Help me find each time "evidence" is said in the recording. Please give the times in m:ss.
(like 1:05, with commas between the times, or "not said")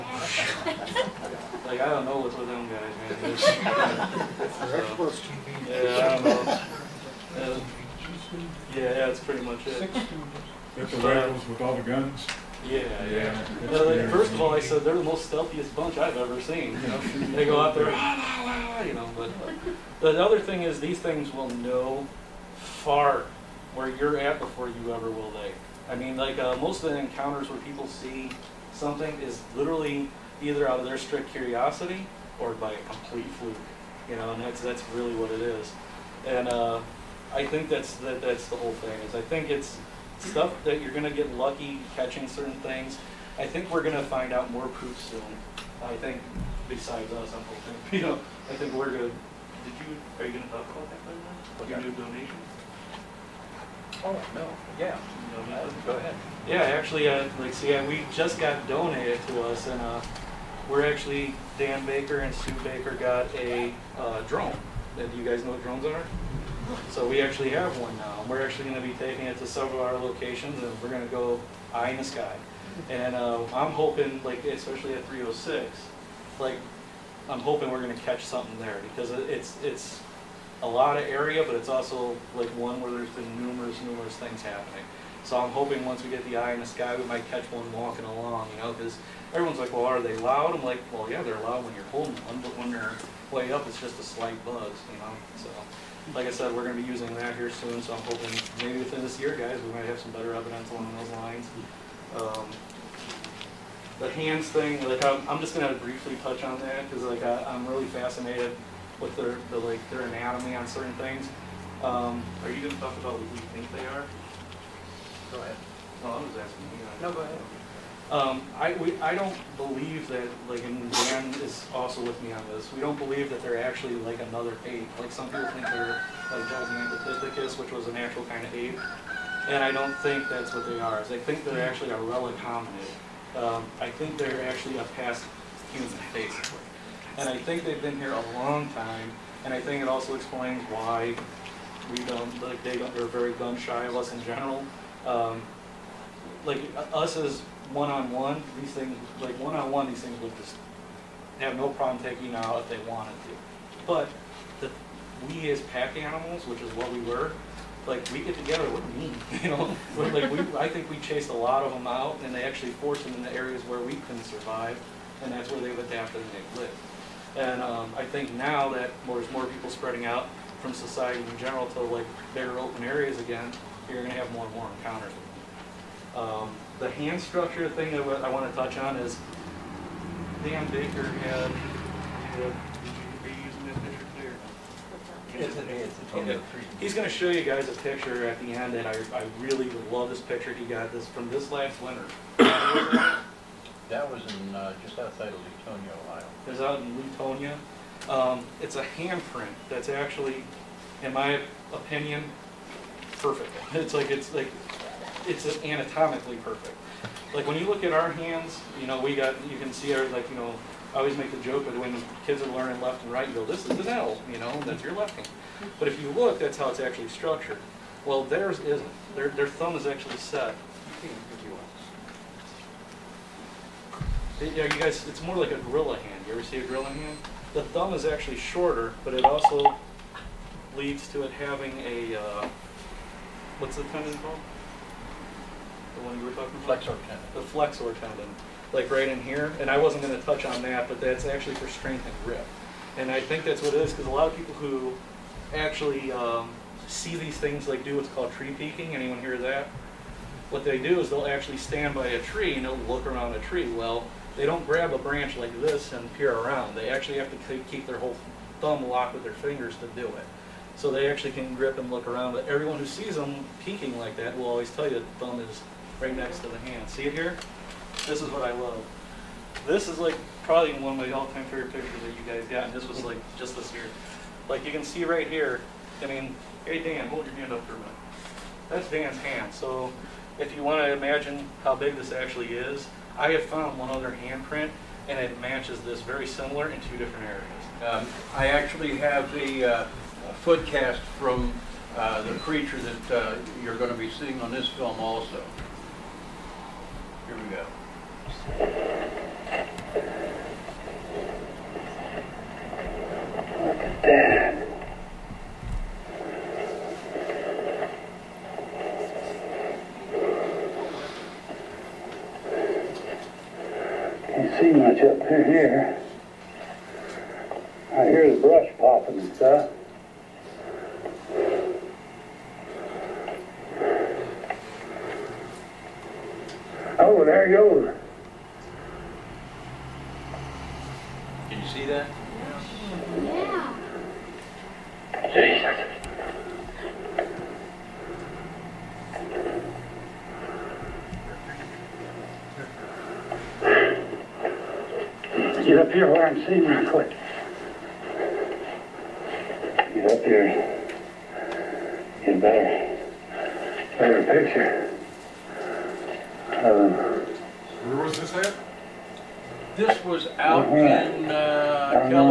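1:40.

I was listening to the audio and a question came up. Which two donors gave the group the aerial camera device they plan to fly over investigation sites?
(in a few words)
Dan Baker and Sue Baker.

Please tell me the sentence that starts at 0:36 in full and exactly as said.
And uh, I think that's that, that's the whole thing.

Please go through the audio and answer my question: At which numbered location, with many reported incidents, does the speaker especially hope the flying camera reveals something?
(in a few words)
306.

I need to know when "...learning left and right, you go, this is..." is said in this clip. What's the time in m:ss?
3:32.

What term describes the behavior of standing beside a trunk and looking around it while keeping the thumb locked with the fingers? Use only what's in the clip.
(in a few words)
Tree peaking.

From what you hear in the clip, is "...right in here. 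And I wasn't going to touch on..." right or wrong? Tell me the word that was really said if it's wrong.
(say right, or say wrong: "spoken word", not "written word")
right.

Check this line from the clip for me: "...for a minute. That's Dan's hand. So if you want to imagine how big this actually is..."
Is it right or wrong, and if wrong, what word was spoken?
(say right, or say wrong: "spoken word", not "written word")
right.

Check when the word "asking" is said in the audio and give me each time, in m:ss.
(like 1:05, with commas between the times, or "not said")
1:56.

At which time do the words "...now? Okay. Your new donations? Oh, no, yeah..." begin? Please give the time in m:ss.
0:51.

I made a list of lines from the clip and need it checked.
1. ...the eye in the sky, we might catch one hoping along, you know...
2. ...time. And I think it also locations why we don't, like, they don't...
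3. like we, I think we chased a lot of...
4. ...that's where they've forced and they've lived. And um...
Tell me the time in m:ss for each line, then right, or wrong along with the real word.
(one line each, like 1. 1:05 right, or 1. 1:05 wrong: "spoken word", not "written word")
1. 1:26 wrong: "walking", not "hoping"
2. 2:18 wrong: "explains", not "locations"
3. 2:39 right
4. 2:45 wrong: "adapted", not "forced".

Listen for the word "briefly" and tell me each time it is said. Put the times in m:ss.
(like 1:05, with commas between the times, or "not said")
1:45.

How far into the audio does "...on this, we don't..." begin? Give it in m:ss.
2:02.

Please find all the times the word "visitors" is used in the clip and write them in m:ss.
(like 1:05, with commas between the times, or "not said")
not said.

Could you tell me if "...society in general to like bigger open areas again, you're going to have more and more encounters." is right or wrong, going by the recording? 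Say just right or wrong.
right.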